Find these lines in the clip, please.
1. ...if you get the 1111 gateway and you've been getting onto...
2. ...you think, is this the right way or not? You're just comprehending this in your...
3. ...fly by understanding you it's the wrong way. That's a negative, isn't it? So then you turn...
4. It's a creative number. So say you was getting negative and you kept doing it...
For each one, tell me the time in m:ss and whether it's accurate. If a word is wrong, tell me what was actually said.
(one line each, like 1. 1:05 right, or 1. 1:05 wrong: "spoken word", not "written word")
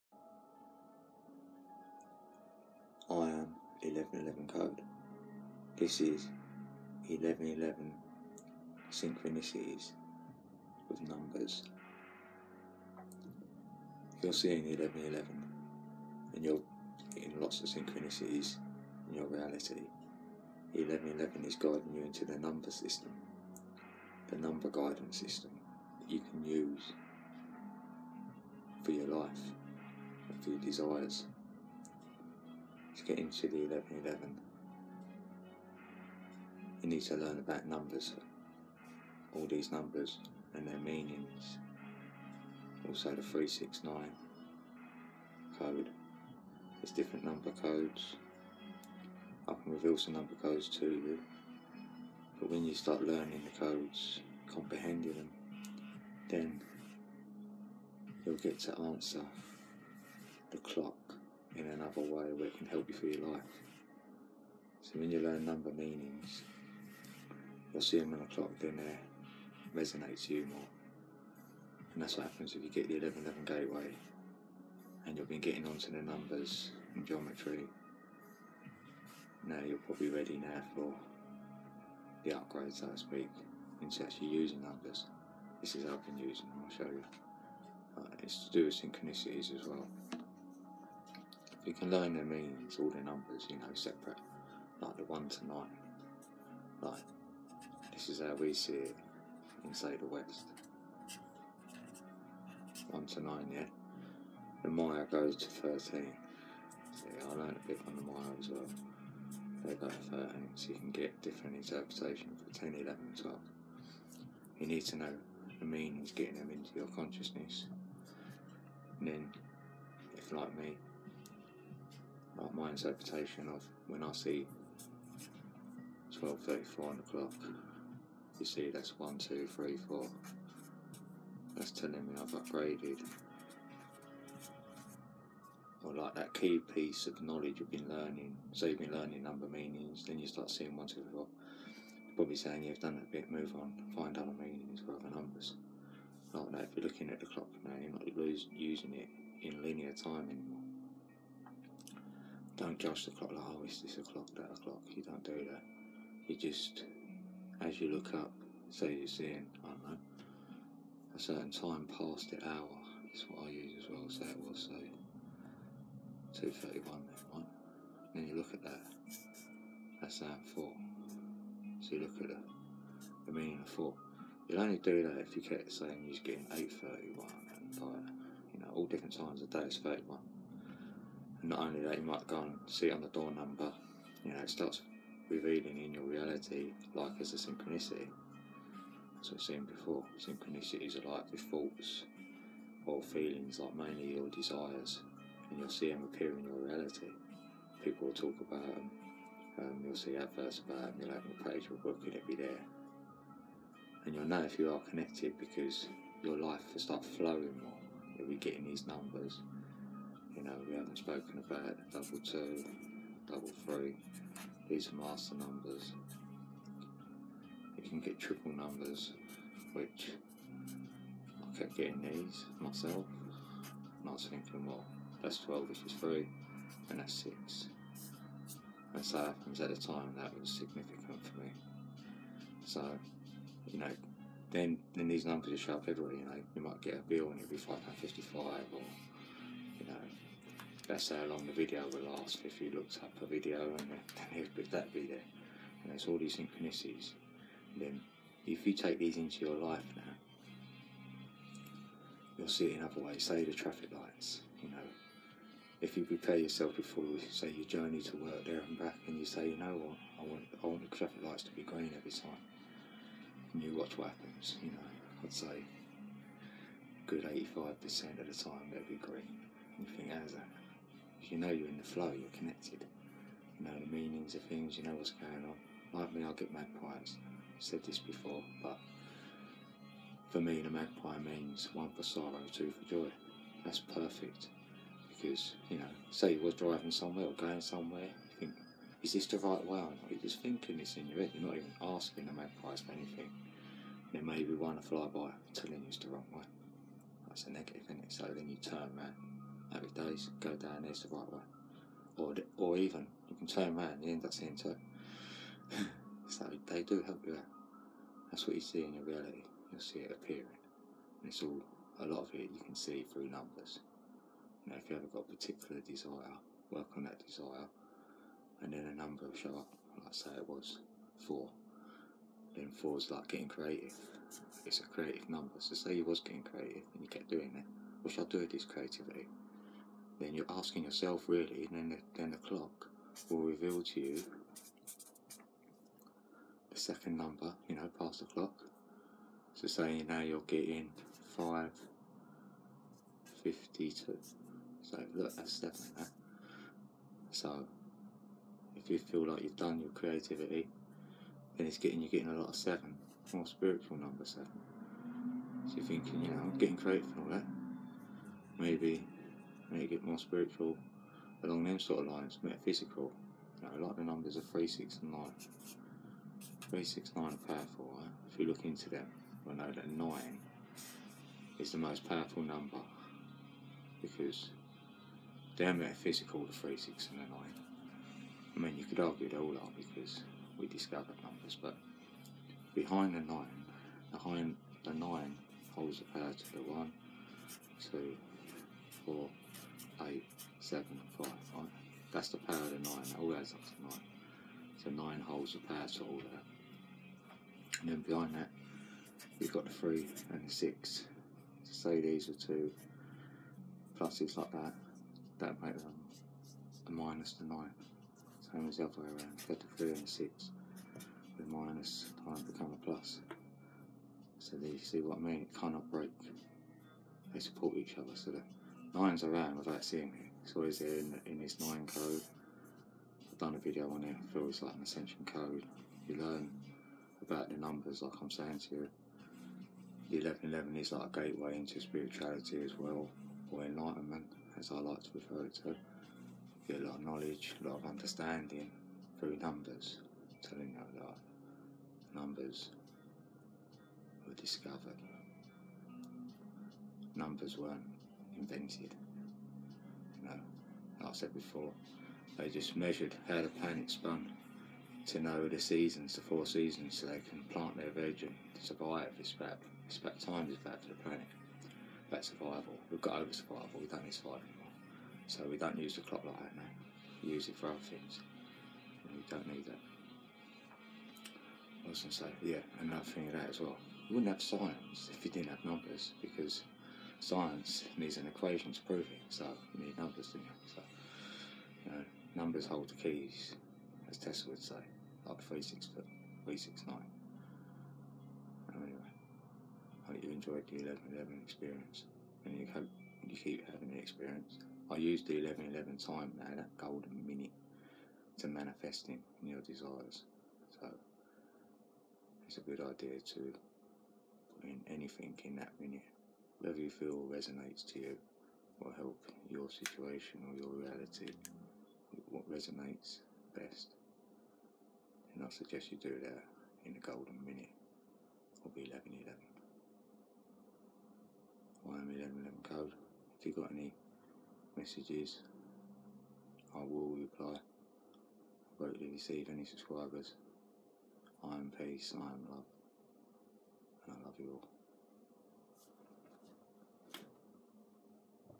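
1. 1:12 right
2. 4:48 wrong: "thinking", not "comprehending"
3. 4:54 wrong: "telling", not "understanding"
4. 5:24 wrong: "creative", not "negative".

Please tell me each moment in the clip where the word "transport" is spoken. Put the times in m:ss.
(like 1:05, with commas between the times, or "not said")
not said.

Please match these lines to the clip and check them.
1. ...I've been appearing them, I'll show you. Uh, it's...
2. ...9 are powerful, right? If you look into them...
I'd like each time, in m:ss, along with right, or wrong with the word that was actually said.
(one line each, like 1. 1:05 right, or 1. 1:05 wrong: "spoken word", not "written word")
1. 1:25 wrong: "using", not "appearing"
2. 6:07 right.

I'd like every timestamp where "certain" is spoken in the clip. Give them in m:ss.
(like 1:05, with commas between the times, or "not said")
2:41.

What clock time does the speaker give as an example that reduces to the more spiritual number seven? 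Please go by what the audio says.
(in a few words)
552.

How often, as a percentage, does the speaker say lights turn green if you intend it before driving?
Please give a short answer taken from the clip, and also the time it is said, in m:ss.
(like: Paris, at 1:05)
85%, at 4:27.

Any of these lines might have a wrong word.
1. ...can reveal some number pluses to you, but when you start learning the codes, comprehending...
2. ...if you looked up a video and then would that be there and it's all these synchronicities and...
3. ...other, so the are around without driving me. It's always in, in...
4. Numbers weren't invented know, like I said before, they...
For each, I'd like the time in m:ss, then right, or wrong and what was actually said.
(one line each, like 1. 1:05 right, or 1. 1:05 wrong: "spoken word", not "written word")
1. 0:49 wrong: "codes", not "pluses"
2. 4:02 right
3. 6:57 wrong: "seeing", not "driving"
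4. 7:27 right.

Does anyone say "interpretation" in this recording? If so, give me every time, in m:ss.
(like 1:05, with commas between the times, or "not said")
1:51, 2:02.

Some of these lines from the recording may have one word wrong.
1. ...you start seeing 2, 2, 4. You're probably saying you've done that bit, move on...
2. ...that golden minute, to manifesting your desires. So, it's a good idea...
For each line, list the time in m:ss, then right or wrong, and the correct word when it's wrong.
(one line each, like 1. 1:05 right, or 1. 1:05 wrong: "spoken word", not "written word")
1. 2:20 wrong: "1", not "2"
2. 8:16 right.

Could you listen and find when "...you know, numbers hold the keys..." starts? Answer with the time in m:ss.
8:01.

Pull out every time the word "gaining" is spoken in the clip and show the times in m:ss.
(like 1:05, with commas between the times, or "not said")
not said.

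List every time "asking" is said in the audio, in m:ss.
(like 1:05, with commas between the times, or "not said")
4:51, 5:30.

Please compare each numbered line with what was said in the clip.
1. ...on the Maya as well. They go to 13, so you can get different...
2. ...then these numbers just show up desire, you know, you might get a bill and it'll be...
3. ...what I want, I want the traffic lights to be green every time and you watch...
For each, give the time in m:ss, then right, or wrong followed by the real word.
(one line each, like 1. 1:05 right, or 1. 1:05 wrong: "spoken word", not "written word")
1. 1:47 right
2. 3:54 wrong: "everywhere", not "desire"
3. 4:19 right.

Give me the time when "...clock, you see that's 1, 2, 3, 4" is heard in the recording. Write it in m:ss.
2:07.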